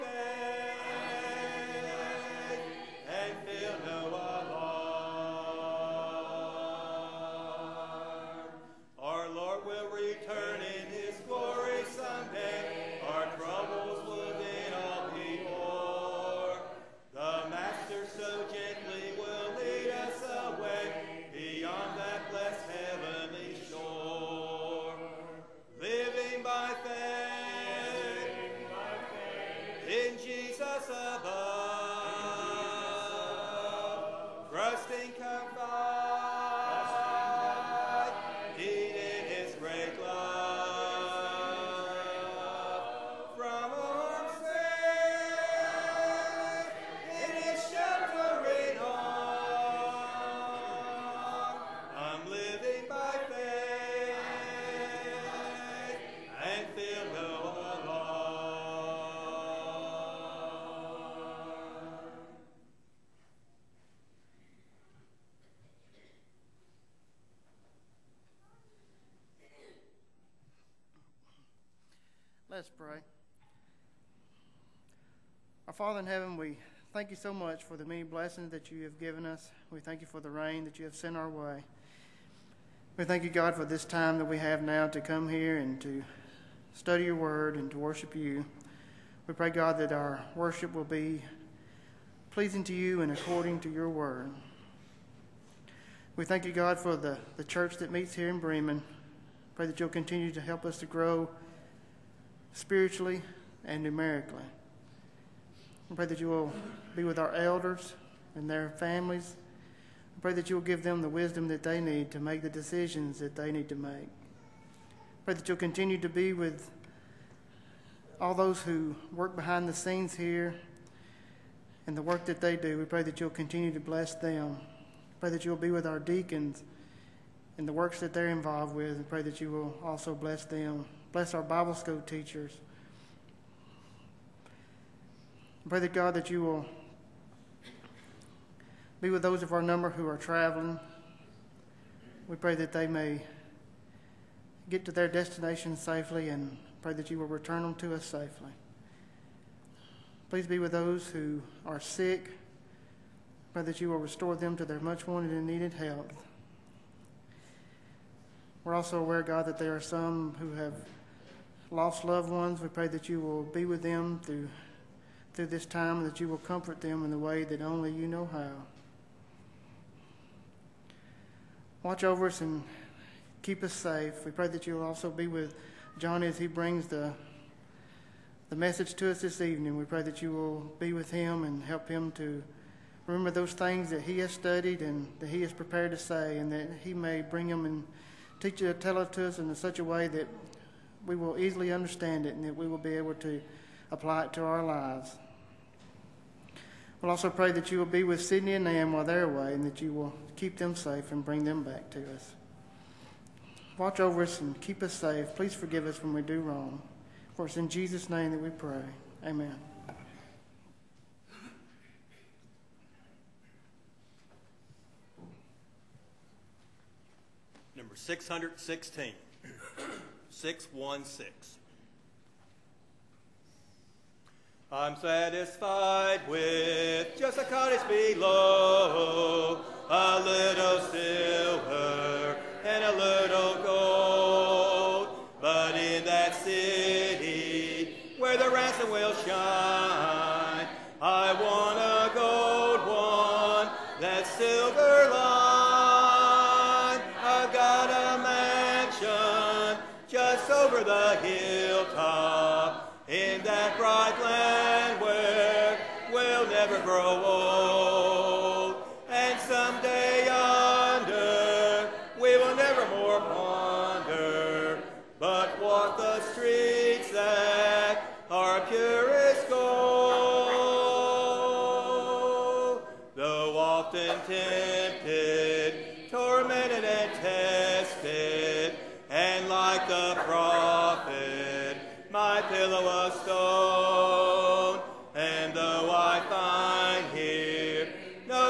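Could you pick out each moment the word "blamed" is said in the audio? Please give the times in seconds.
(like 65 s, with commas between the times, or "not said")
not said.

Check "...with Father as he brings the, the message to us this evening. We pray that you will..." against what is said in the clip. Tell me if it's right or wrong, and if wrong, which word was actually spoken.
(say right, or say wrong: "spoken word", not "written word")
wrong: "John", not "Father".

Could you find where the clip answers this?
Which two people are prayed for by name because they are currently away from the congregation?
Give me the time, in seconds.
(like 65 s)
198 s.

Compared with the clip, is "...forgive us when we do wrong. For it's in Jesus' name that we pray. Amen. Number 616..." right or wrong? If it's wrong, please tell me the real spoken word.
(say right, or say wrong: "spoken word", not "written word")
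right.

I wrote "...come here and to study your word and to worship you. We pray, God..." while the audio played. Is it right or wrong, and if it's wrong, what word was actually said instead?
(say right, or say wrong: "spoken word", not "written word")
right.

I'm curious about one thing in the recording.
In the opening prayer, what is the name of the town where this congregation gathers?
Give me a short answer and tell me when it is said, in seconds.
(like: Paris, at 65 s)
Bremen, at 98 s.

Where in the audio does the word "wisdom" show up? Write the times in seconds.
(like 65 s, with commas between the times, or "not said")
111 s.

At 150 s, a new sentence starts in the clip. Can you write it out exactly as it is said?
Please be with those who are sick.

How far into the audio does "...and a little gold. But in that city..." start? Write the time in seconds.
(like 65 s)
232 s.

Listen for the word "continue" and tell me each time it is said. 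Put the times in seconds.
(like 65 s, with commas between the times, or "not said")
99 s, 115 s, 123 s.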